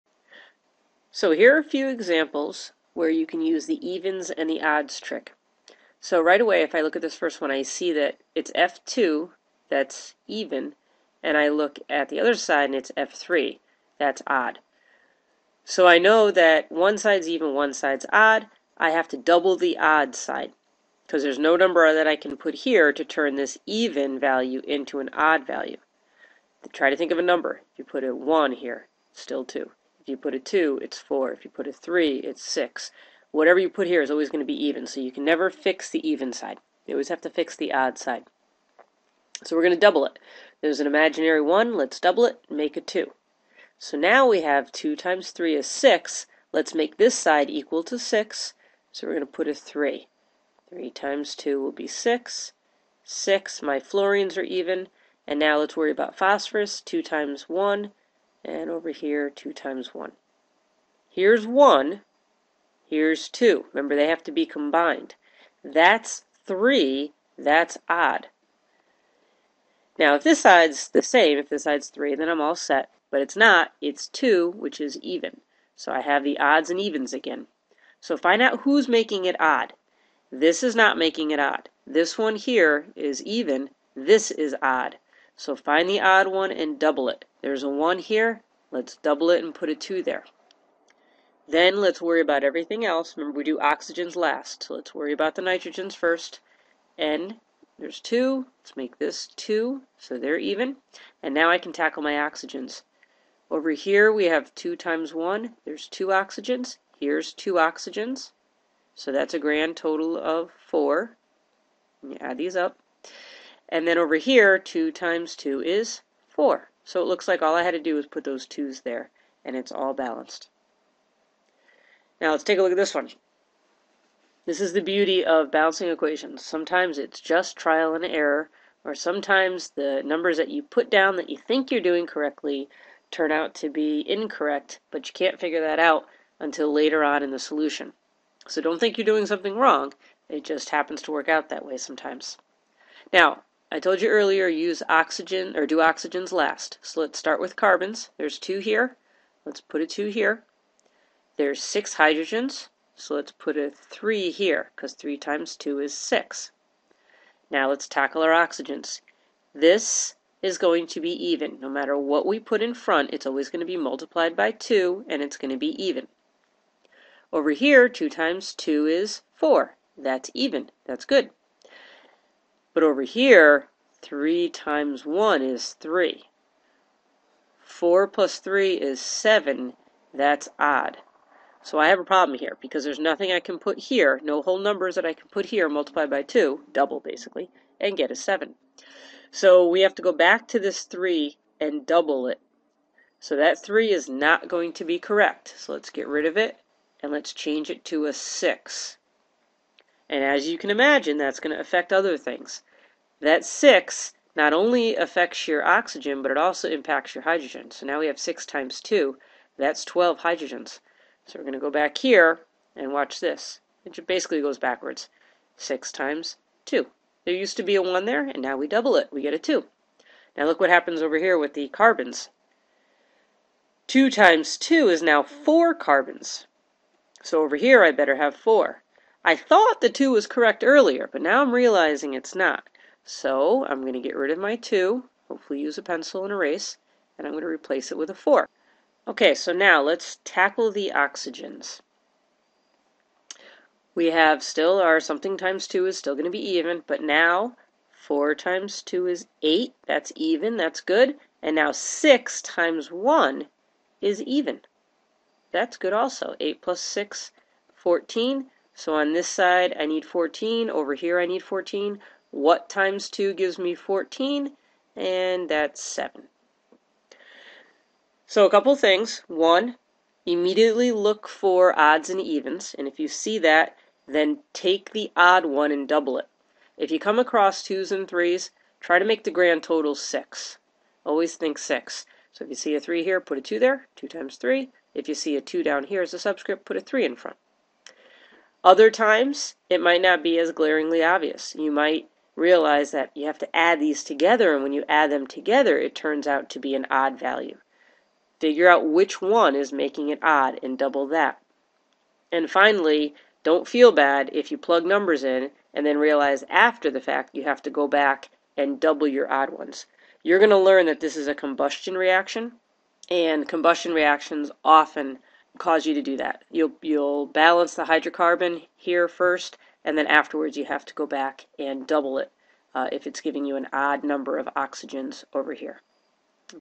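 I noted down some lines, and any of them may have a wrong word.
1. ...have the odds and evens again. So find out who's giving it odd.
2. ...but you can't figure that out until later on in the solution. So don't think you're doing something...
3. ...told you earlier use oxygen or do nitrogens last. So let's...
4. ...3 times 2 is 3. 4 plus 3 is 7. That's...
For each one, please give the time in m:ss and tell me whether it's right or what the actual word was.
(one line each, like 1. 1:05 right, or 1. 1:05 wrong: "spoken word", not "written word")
1. 1:15 wrong: "making", not "giving"
2. 2:14 right
3. 2:23 wrong: "oxygens", not "nitrogens"
4. 2:54 wrong: "1", not "2".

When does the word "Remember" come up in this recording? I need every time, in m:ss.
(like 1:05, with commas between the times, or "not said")
1:03, 1:33.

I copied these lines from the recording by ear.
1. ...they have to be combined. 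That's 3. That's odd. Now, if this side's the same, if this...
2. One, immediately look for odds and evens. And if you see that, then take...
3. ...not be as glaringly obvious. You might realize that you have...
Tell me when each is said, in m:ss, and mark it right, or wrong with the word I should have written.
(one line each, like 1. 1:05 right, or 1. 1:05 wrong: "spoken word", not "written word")
1. 1:03 right
2. 4:29 right
3. 4:50 right.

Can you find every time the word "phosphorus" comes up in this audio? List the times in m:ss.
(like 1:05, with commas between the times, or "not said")
0:56.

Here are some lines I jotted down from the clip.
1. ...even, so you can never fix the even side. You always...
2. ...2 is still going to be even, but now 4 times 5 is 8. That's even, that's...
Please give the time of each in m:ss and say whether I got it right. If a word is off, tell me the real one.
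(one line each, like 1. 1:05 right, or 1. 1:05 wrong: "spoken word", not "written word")
1. 0:34 right
2. 4:05 wrong: "2", not "5".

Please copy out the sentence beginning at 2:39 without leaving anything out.
This is going to be even.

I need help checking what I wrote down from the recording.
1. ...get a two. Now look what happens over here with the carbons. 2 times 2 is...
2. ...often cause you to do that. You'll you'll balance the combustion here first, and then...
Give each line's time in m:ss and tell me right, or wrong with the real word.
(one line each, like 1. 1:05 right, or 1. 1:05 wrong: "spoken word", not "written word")
1. 3:39 right
2. 5:14 wrong: "hydrocarbon", not "combustion".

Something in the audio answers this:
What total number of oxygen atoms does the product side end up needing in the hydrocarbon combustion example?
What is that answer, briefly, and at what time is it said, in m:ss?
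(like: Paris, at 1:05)
14, at 4:16.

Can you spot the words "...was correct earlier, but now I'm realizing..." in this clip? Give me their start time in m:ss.
3:50.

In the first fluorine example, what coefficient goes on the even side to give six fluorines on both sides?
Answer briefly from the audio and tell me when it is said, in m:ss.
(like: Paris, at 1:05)
3, at 0:49.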